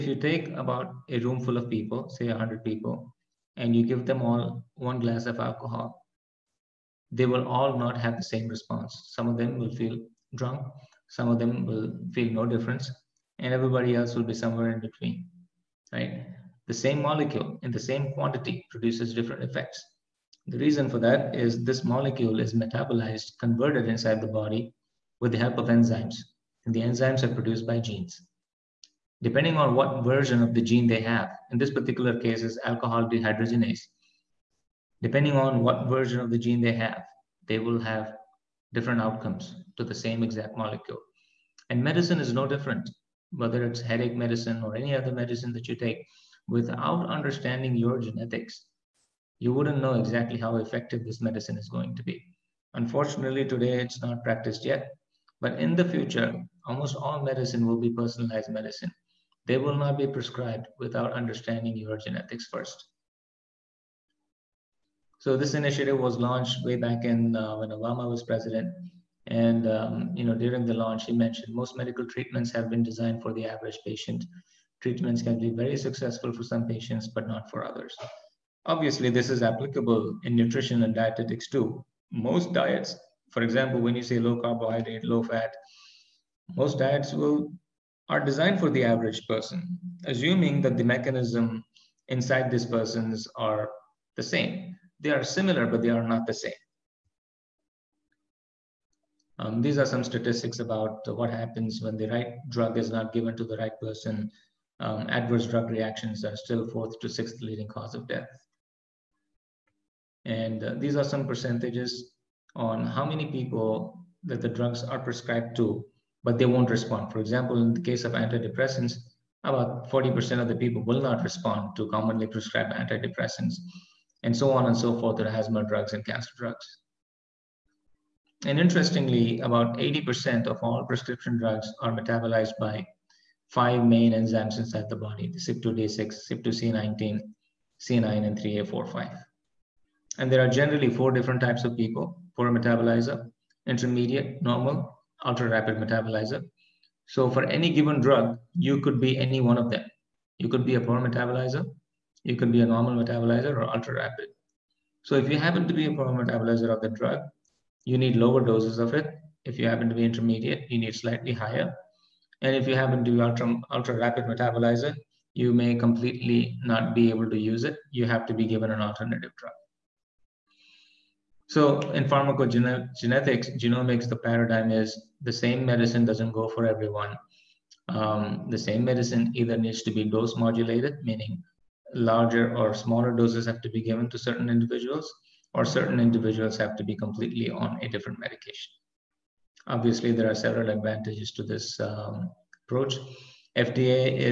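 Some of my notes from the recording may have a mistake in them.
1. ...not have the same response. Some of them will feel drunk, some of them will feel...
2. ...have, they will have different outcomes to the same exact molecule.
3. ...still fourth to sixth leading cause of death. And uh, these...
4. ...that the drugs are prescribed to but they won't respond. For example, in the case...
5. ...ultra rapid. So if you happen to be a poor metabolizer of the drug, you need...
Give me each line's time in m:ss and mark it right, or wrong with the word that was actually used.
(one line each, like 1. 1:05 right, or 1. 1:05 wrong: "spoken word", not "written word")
1. 0:07 right
2. 0:36 right
3. 1:46 right
4. 1:54 right
5. 2:33 right.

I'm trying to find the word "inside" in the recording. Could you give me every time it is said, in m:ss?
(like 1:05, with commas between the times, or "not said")
0:23, 1:32, 2:14.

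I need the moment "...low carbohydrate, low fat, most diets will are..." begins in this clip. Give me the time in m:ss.
1:24.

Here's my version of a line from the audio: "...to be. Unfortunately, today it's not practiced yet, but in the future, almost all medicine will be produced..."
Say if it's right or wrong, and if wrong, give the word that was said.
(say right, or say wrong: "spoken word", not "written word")
wrong: "personalized", not "produced".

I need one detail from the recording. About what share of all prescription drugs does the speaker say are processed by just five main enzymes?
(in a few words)
80%.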